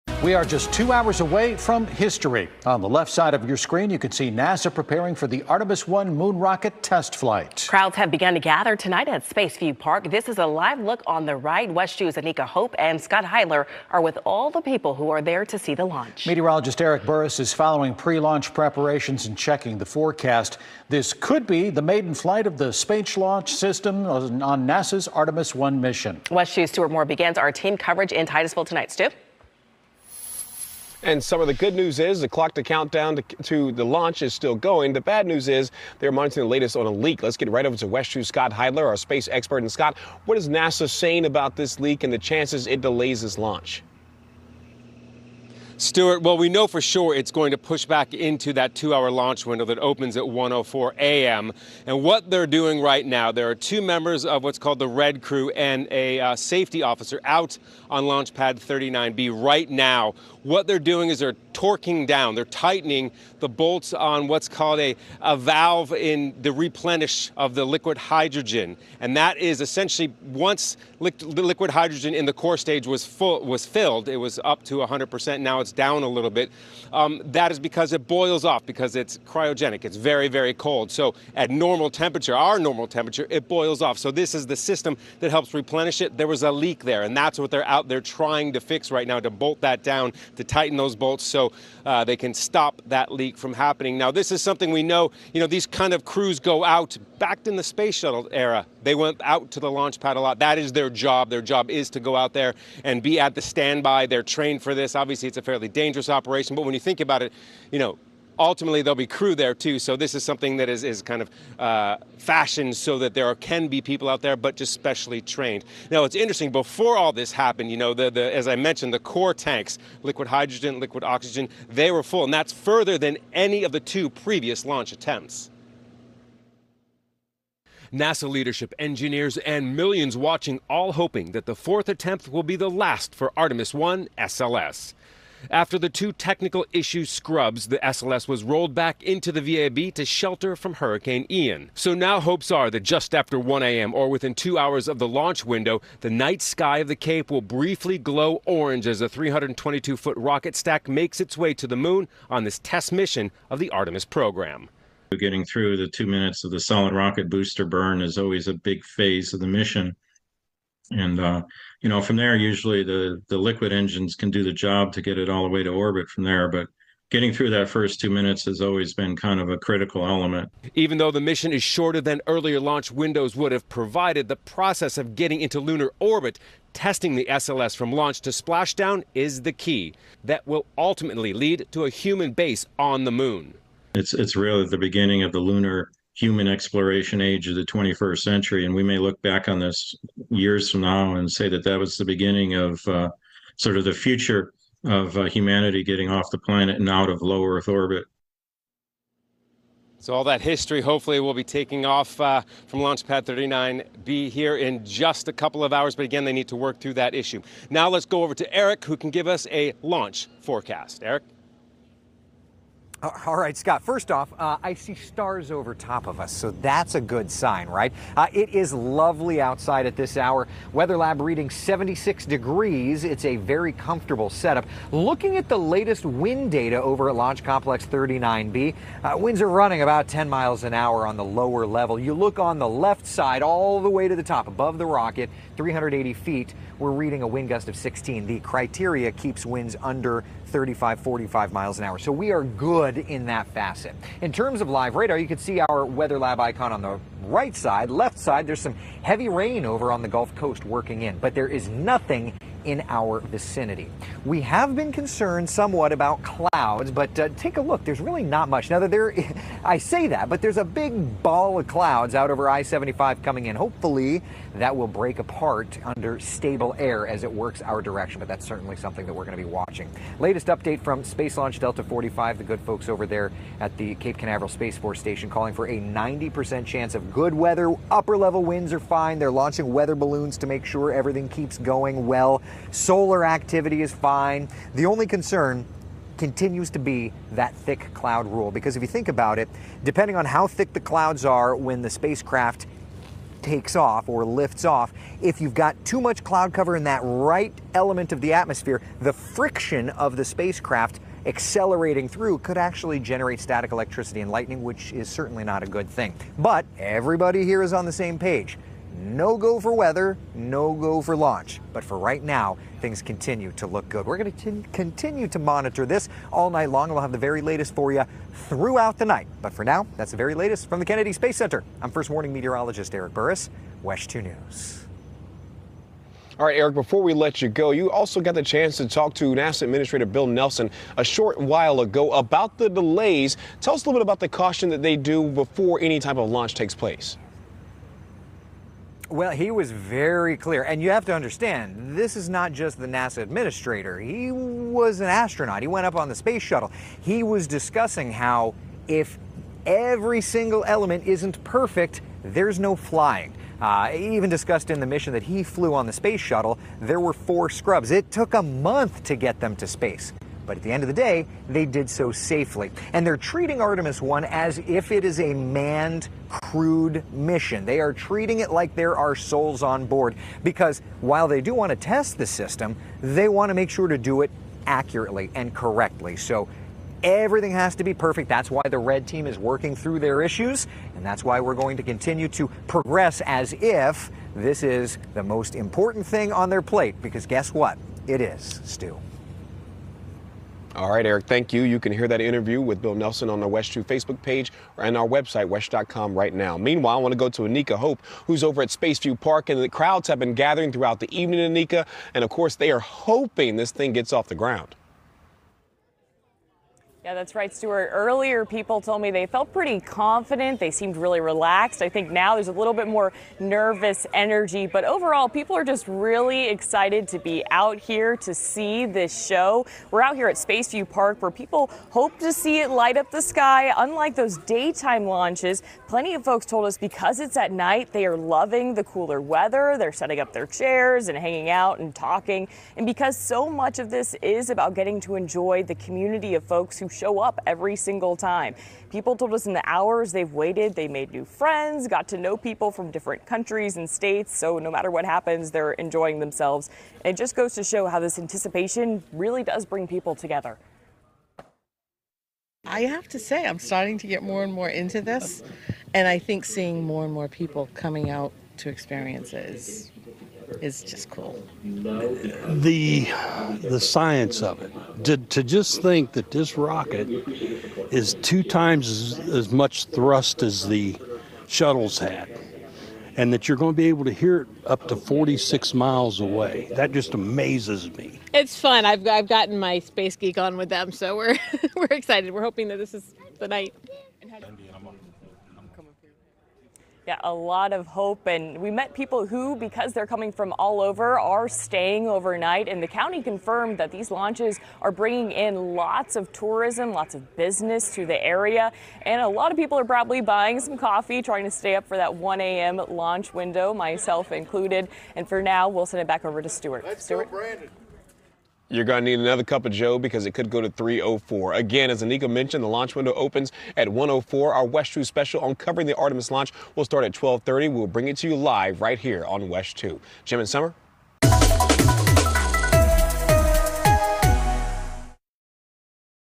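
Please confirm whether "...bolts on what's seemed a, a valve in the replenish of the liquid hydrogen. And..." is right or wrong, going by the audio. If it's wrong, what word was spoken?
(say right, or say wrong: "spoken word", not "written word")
wrong: "called", not "seemed".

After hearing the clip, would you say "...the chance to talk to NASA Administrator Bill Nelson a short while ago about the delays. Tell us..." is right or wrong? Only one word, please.
right.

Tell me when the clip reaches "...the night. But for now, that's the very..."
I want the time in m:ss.
5:18.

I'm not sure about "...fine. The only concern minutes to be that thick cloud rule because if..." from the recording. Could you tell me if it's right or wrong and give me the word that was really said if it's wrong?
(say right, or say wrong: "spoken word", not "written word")
wrong: "continues", not "minutes".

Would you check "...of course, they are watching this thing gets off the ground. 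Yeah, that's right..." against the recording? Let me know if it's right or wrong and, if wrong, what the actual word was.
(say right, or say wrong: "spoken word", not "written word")
wrong: "hoping", not "watching".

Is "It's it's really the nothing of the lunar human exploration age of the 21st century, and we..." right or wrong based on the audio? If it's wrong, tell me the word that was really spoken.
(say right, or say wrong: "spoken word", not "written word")
wrong: "beginning", not "nothing".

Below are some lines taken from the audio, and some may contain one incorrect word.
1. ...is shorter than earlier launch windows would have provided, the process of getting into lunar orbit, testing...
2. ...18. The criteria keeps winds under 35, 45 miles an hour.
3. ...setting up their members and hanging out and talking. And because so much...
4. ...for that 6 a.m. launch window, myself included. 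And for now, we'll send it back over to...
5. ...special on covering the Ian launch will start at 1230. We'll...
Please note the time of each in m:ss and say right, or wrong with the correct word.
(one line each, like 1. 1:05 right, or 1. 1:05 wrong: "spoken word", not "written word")
1. 2:51 right
2. 3:57 wrong: "16", not "18"
3. 7:09 wrong: "chairs", not "members"
4. 8:21 wrong: "1", not "6"
5. 8:35 wrong: "Artemis", not "Ian".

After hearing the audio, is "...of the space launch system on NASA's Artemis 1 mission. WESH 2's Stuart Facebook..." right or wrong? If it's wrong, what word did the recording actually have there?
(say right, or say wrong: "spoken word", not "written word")
wrong: "Moore", not "Facebook".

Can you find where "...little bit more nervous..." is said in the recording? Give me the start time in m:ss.
6:52.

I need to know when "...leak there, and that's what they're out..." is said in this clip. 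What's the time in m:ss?
1:26.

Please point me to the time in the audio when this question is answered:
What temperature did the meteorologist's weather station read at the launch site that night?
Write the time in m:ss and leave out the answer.
3:41.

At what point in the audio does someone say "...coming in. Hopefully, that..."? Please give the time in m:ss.
4:23.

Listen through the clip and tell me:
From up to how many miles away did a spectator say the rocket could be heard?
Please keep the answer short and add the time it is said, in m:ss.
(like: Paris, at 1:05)
46 miles, at 7:54.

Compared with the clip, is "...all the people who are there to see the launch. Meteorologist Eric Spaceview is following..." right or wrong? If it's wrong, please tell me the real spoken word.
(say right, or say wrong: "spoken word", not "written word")
wrong: "Burris", not "Spaceview".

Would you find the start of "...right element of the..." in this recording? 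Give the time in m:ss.
4:57.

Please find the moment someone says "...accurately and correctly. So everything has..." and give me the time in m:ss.
6:14.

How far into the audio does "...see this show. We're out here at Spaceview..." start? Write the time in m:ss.
6:58.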